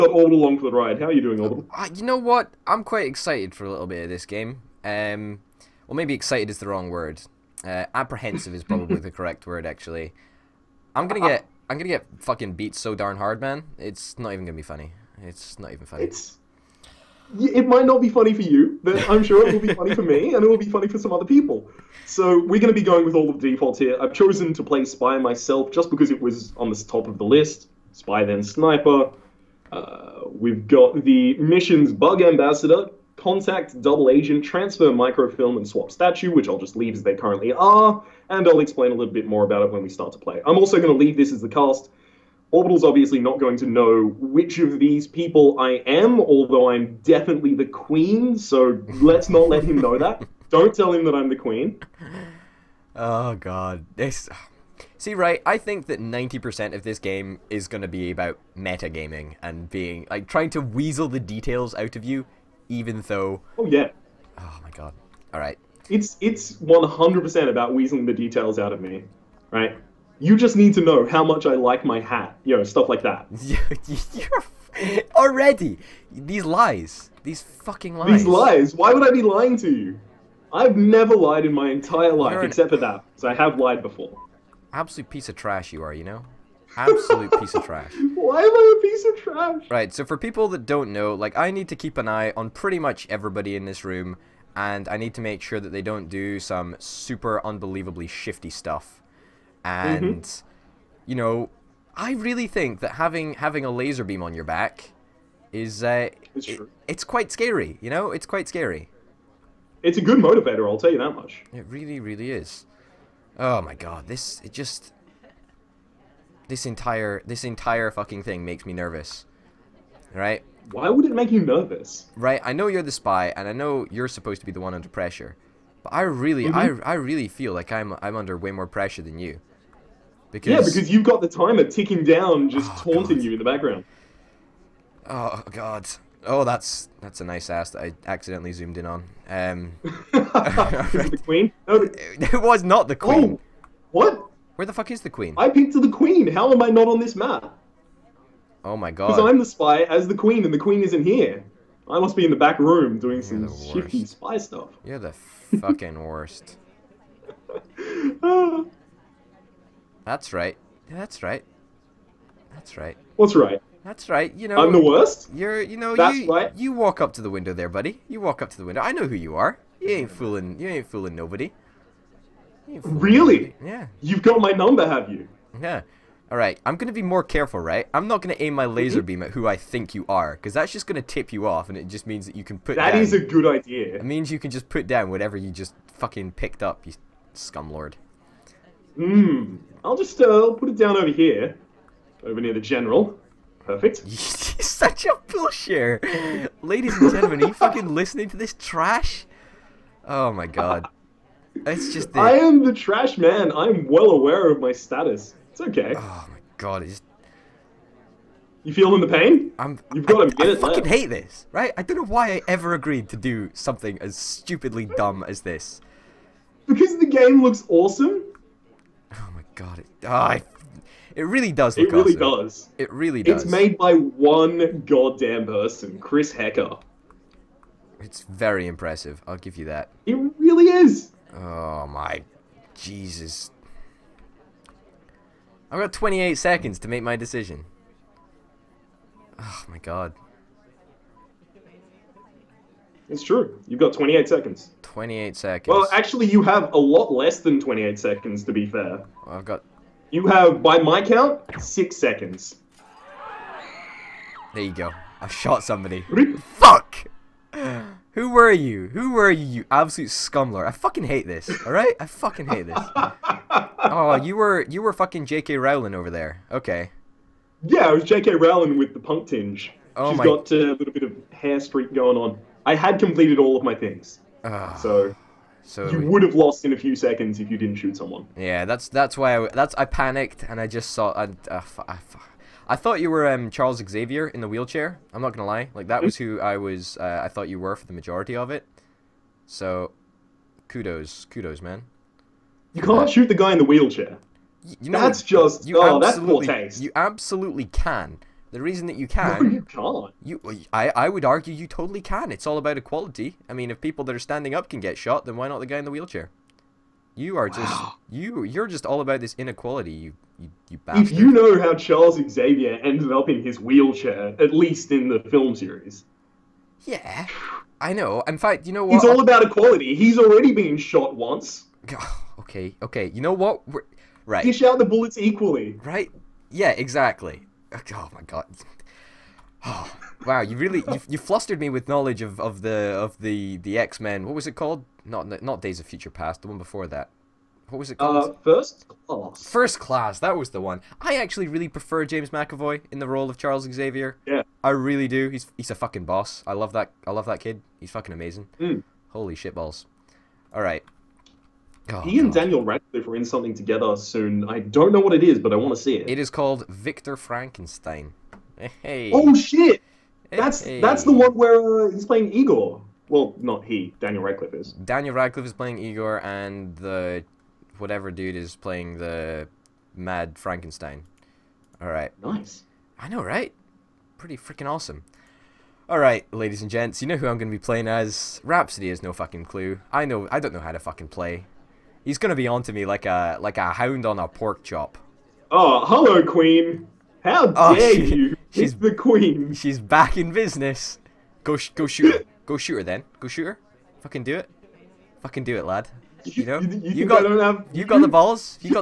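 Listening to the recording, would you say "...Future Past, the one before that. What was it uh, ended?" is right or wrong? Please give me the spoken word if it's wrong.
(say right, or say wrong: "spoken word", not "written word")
wrong: "called", not "ended".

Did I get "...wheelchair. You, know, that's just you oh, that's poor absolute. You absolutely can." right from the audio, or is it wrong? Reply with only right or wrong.
wrong.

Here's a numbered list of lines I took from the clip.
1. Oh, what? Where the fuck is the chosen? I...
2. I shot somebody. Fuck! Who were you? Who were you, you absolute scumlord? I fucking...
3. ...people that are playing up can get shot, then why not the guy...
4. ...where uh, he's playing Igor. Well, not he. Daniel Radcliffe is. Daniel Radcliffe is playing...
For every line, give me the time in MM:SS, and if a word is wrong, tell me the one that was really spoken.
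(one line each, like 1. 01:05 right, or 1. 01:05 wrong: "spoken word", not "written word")
1. 02:23 wrong: "queen", not "chosen"
2. 04:15 right
3. 05:03 wrong: "standing", not "playing"
4. 06:01 right.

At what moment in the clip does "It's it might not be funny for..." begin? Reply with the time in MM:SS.
00:16.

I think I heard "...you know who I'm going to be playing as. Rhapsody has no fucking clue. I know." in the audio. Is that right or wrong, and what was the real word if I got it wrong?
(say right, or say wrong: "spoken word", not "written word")
right.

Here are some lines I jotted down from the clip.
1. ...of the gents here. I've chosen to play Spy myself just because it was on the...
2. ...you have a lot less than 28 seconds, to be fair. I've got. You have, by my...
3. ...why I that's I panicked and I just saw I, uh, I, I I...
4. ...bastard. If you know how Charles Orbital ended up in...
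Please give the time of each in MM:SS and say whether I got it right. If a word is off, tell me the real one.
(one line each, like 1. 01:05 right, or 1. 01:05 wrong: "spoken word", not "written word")
1. 00:23 wrong: "defaults", not "gents"
2. 04:06 right
3. 04:39 right
4. 05:10 wrong: "Xavier", not "Orbital".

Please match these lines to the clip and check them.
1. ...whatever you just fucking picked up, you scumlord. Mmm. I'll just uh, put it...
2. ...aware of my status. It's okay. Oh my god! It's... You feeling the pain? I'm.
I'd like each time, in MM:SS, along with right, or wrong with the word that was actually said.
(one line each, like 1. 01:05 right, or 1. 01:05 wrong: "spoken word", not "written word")
1. 03:05 right
2. 03:24 right.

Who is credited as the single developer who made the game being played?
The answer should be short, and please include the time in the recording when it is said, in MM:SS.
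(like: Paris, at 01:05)
Chris Hecker, at 03:45.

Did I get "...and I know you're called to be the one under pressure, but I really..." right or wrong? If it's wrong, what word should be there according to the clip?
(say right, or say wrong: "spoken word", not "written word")
wrong: "supposed", not "called".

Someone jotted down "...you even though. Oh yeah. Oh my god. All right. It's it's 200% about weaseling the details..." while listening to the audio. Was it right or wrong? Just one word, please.
wrong.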